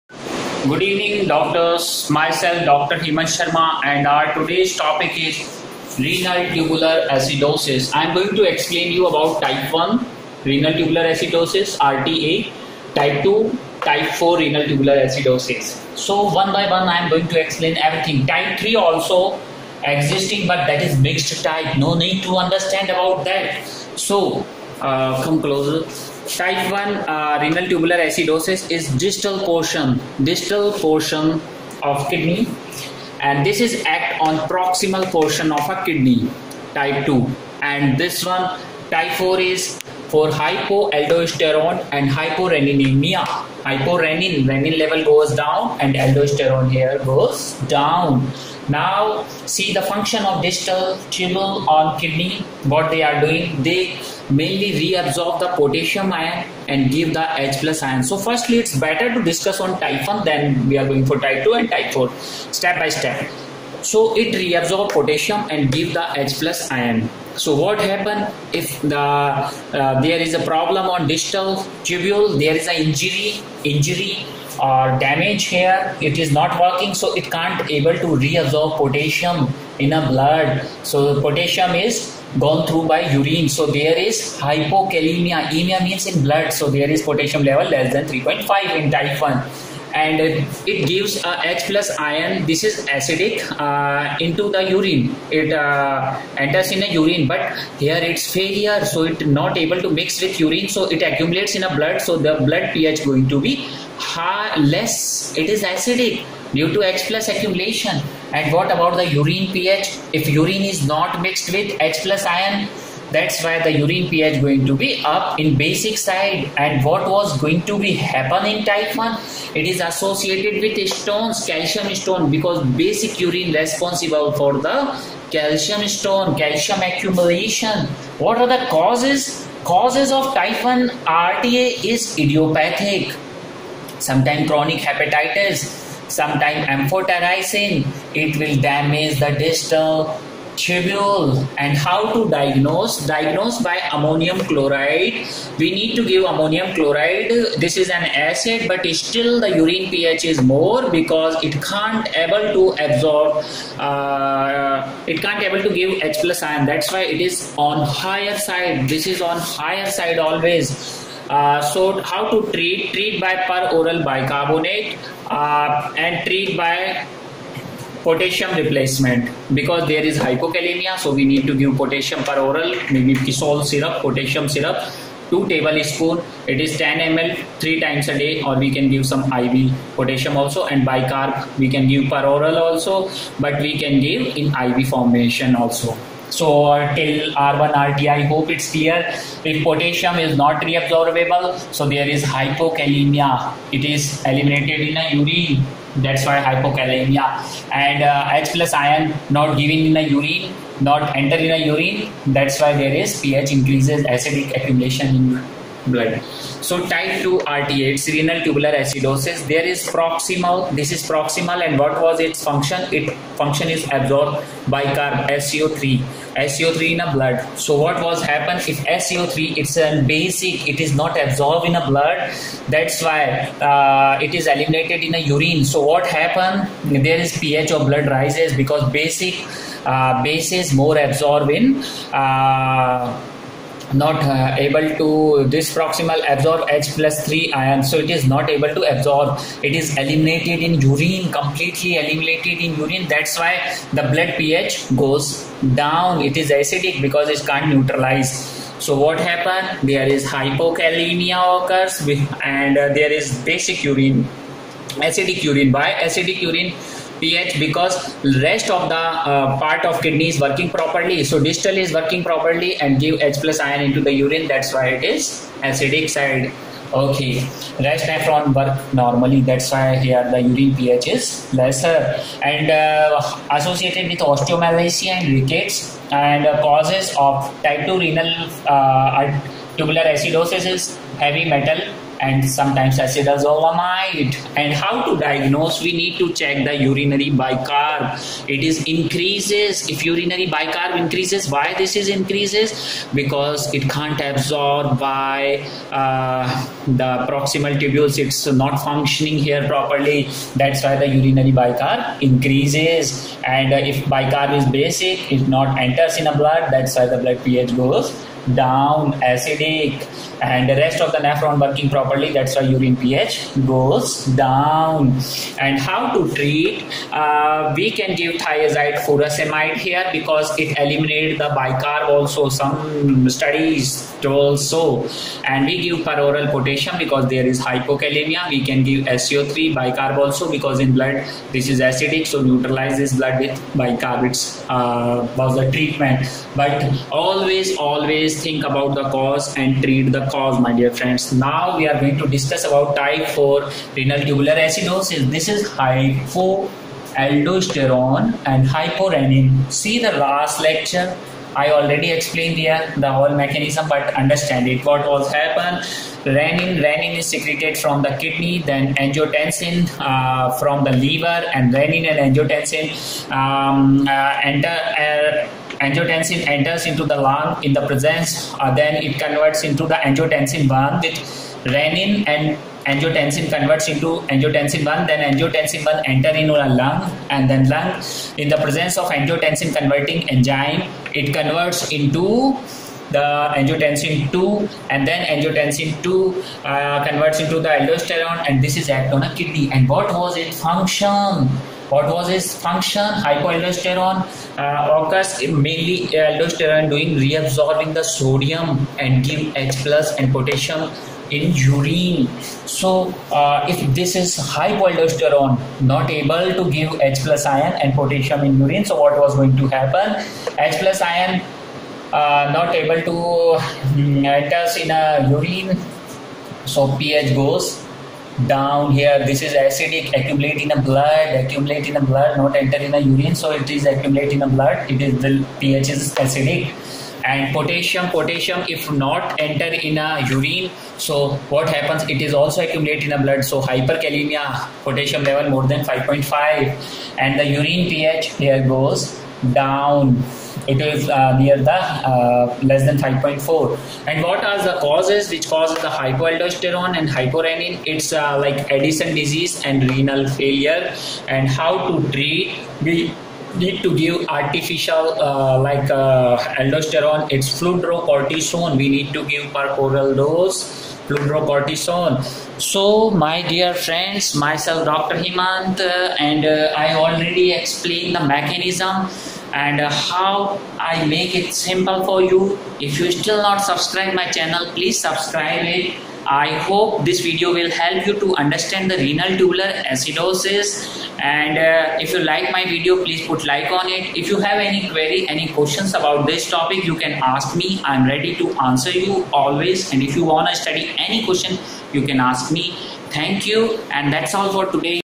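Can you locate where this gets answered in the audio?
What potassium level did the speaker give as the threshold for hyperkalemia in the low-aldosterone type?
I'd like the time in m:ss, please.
7:15.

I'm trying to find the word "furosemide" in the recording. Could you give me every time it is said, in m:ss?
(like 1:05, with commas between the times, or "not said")
5:19.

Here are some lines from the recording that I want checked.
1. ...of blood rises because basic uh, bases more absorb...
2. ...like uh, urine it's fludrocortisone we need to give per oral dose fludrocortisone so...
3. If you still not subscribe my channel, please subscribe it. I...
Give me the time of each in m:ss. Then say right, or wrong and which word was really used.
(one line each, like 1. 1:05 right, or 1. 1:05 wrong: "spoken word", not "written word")
1. 3:47 right
2. 7:35 wrong: "aldosterone", not "urine"
3. 7:52 right.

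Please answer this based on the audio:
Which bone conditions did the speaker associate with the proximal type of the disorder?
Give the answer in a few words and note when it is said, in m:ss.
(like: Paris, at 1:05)
Osteomalacia and rickets, at 4:34.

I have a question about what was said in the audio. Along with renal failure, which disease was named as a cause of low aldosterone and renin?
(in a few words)
Addison disease.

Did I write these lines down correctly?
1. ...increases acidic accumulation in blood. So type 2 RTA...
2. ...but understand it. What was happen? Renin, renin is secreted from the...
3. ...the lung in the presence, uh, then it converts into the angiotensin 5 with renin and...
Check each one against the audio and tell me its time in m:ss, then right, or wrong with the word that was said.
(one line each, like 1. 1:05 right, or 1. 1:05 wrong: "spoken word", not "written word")
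1. 3:23 right
2. 5:53 right
3. 6:07 wrong: "1", not "5".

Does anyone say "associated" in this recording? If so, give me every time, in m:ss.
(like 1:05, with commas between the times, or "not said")
1:59, 4:33.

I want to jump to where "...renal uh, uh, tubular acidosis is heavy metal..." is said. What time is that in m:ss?
4:37.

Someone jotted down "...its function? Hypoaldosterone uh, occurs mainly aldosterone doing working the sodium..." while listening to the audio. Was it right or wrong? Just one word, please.
wrong.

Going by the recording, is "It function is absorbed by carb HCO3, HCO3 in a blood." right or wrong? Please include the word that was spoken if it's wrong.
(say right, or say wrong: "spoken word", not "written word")
right.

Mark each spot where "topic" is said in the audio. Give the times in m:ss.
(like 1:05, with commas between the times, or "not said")
0:04, 8:06.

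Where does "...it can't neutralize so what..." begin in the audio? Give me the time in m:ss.
4:07.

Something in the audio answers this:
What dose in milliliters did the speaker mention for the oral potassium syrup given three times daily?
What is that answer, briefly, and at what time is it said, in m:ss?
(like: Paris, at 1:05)
10 ml, at 2:56.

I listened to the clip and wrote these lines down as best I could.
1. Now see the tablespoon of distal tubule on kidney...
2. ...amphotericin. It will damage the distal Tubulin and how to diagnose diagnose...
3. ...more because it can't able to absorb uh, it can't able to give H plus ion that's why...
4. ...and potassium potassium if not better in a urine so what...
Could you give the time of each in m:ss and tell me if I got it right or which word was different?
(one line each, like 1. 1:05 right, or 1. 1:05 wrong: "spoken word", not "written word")
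1. 0:48 wrong: "function", not "tablespoon"
2. 2:16 right
3. 2:30 right
4. 7:07 wrong: "enter", not "better".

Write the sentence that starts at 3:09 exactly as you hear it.
If potassium is not reabsorbable, so there is hypokalemia.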